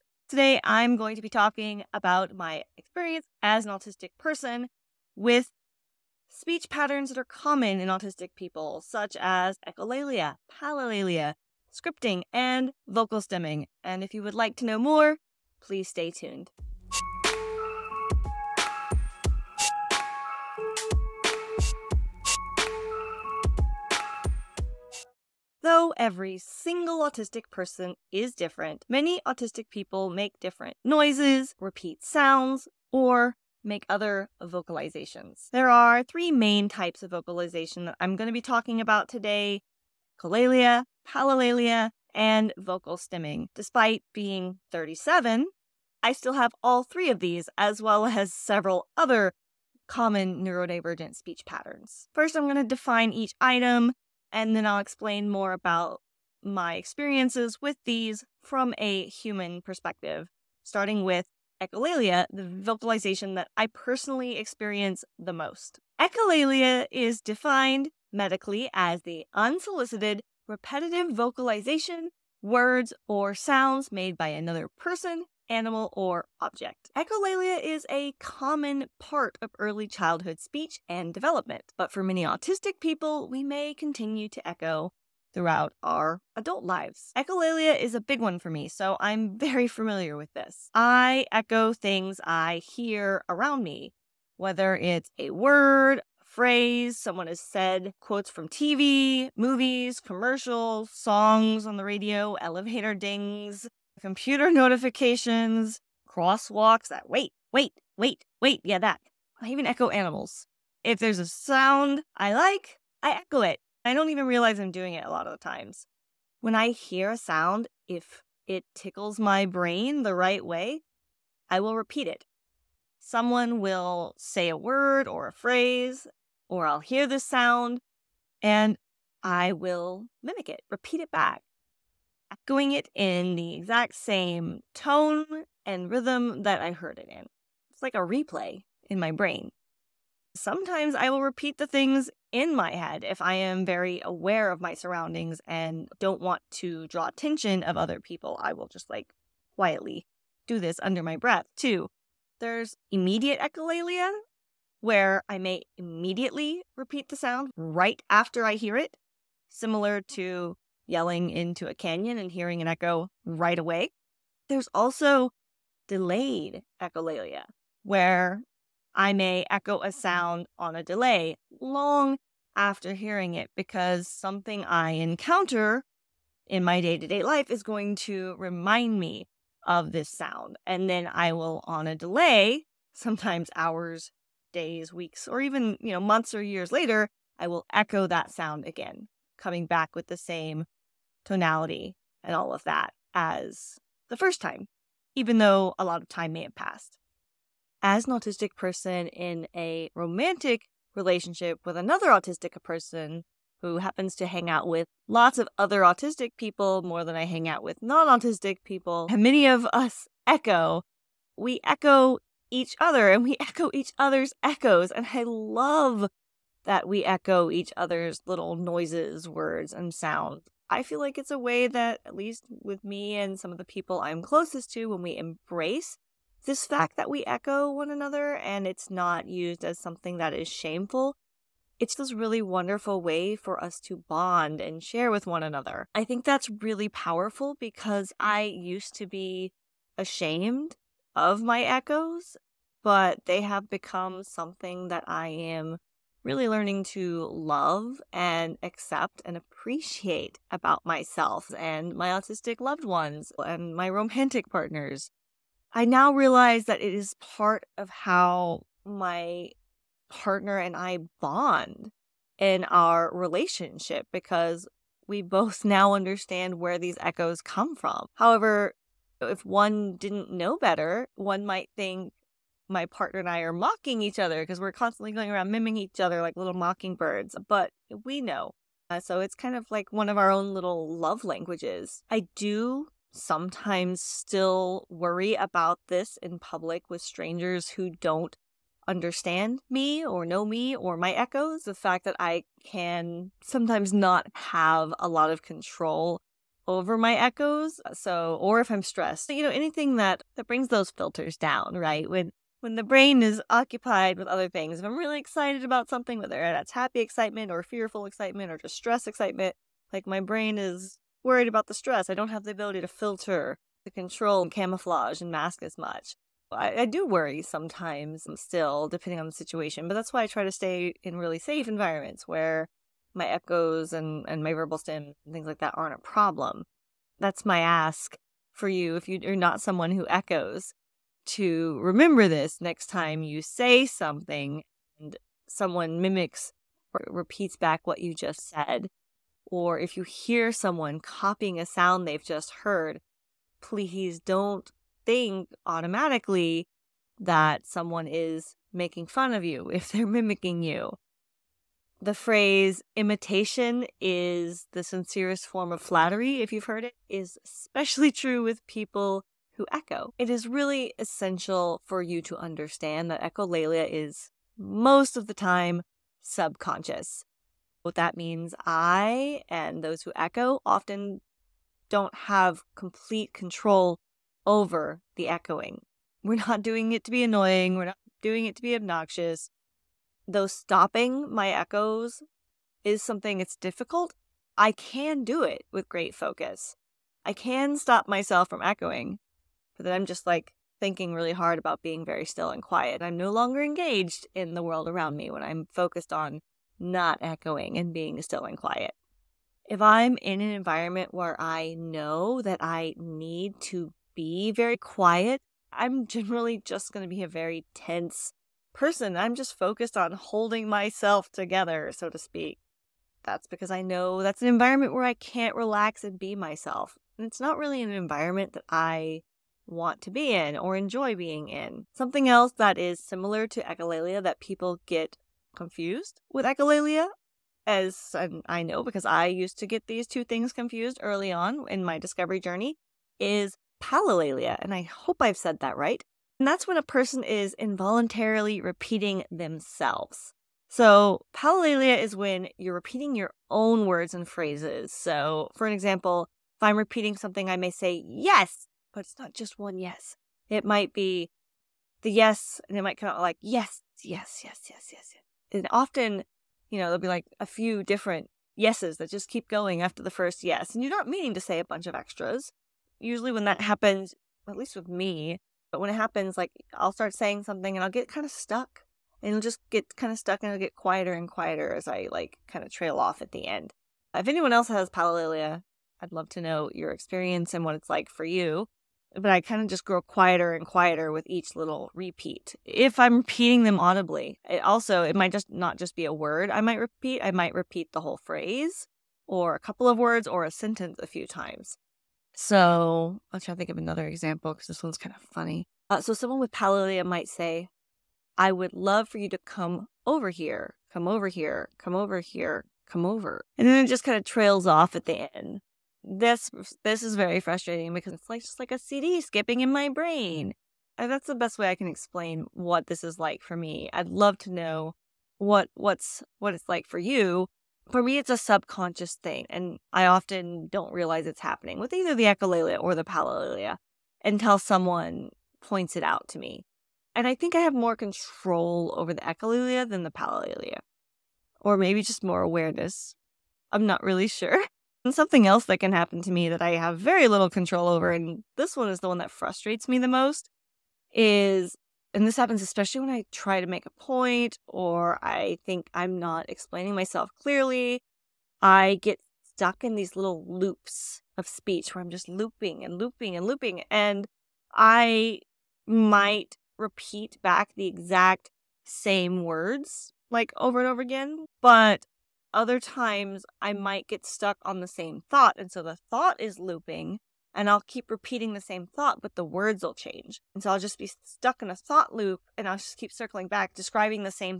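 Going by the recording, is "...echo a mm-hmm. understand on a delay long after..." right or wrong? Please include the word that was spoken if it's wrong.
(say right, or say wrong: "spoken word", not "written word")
wrong: "sound", not "understand".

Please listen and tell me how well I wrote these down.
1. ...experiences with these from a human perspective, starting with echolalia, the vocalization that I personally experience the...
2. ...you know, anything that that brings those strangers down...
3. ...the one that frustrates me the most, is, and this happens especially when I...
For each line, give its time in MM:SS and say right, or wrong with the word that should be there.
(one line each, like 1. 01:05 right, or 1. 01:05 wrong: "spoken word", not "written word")
1. 00:56 right
2. 04:59 wrong: "filters", not "strangers"
3. 08:59 right.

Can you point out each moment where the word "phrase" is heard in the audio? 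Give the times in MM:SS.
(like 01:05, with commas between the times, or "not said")
01:36, 02:05, 05:52, 07:24, 08:08.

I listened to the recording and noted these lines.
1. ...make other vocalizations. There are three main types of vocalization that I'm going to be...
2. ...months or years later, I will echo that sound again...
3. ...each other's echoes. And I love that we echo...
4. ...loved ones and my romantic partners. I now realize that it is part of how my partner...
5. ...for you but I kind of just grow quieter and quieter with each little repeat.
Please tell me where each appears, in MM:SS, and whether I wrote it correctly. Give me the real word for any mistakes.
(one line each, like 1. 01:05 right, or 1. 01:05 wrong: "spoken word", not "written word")
1. 00:33 right
2. 03:05 right
3. 03:33 right
4. 04:12 right
5. 07:58 right.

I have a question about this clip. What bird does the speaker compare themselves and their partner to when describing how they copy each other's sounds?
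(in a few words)
mockingbirds.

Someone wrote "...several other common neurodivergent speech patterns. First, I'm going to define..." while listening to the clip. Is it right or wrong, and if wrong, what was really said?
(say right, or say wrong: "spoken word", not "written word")
right.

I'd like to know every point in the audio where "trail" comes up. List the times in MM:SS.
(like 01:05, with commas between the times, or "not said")
07:52, 08:24.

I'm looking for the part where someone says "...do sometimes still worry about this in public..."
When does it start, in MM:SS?
04:42.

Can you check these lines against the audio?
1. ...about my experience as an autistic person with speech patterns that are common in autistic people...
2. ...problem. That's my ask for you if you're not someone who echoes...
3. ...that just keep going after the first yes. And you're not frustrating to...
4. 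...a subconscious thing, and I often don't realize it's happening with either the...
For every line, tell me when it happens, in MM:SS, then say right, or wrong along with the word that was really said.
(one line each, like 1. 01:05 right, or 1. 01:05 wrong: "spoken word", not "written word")
1. 00:01 right
2. 05:25 right
3. 07:38 wrong: "meaning", not "frustrating"
4. 08:38 right.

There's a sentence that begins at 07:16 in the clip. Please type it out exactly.
And that's when a person is involuntarily repeating themselves.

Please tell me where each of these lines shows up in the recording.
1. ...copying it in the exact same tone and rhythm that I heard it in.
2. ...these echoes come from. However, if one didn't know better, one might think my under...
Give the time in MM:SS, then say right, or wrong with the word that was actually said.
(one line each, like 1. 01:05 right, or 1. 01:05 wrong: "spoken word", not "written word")
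1. 02:12 wrong: "echoing", not "copying"
2. 04:26 wrong: "partner", not "under".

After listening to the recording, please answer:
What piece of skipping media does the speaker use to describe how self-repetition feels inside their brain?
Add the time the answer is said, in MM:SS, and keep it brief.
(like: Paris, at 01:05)
a CD, at 08:28.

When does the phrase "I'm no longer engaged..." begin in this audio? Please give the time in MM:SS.
06:33.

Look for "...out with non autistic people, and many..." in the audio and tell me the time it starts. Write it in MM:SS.
03:27.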